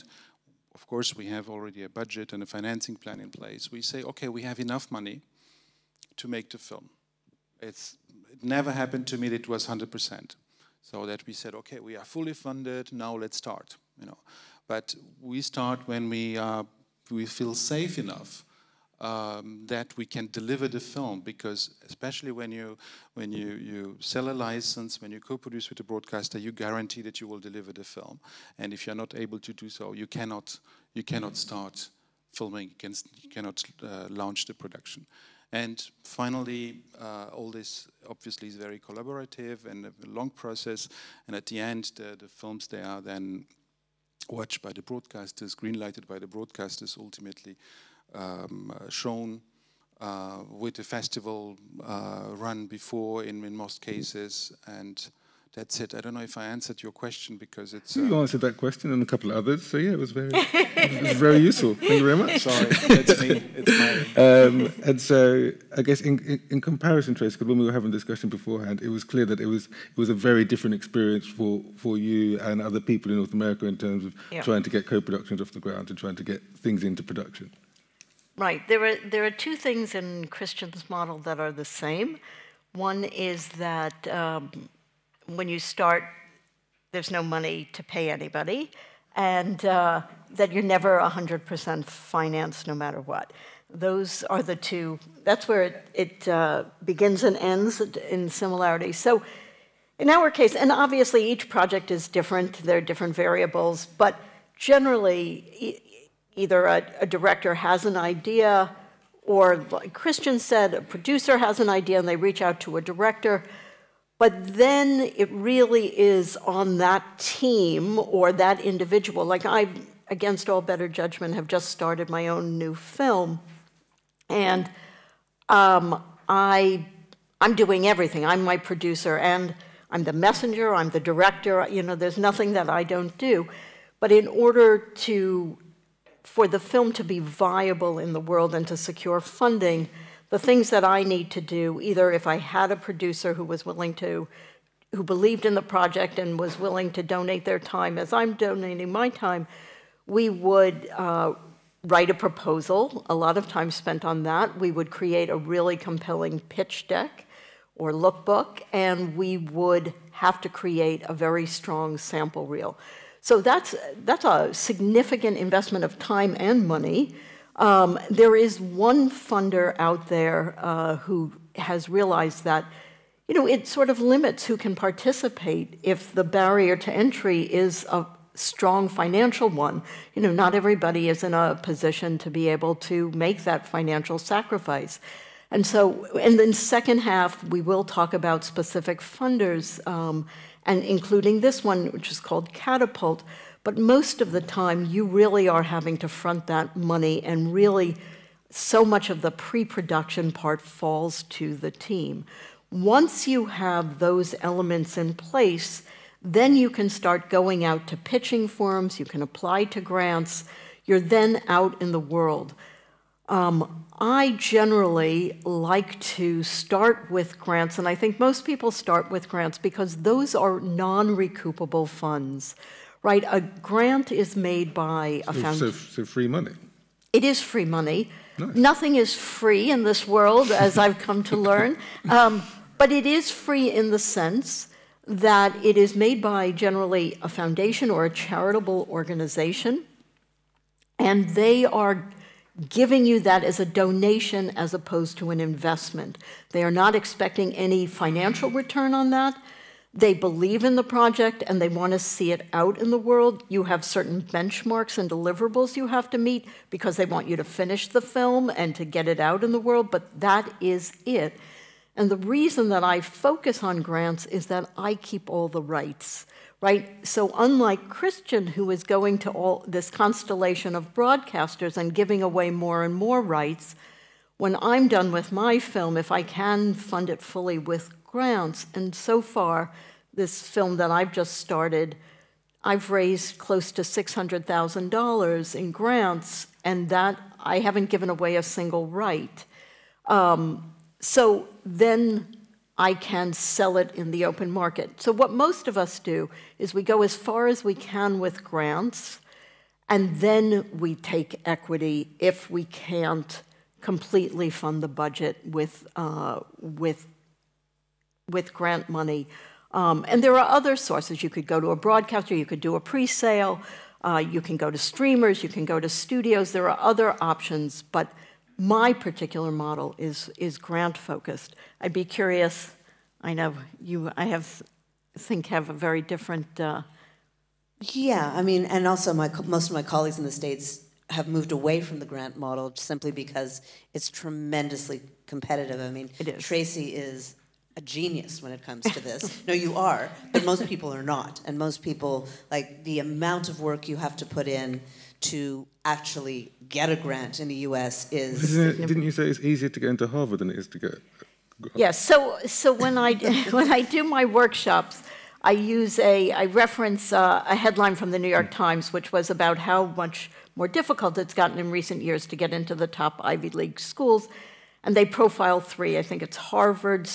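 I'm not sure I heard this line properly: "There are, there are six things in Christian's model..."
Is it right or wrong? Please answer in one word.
wrong.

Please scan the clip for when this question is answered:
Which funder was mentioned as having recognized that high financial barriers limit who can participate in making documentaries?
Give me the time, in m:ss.
3:12.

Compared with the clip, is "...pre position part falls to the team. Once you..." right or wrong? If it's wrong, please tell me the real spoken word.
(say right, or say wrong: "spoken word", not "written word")
wrong: "production", not "position".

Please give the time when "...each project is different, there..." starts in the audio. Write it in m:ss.
1:41.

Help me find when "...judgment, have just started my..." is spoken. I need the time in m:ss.
2:00.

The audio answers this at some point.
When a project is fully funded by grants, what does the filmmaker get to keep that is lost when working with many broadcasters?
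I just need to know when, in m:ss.
4:25.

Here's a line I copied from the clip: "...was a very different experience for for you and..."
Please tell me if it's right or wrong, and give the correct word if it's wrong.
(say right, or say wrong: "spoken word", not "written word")
right.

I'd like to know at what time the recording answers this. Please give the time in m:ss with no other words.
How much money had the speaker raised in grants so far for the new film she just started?
4:43.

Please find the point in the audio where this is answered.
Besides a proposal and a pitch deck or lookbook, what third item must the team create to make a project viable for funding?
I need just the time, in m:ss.
2:41.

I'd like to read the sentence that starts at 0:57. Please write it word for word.
you um, answered that question and a couple of others.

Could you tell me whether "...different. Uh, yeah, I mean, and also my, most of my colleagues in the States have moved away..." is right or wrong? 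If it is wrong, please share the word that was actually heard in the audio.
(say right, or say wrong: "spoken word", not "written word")
right.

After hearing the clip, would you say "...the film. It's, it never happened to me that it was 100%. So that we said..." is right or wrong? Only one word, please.
right.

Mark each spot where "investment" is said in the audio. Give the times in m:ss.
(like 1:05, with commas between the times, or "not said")
2:45, 4:05.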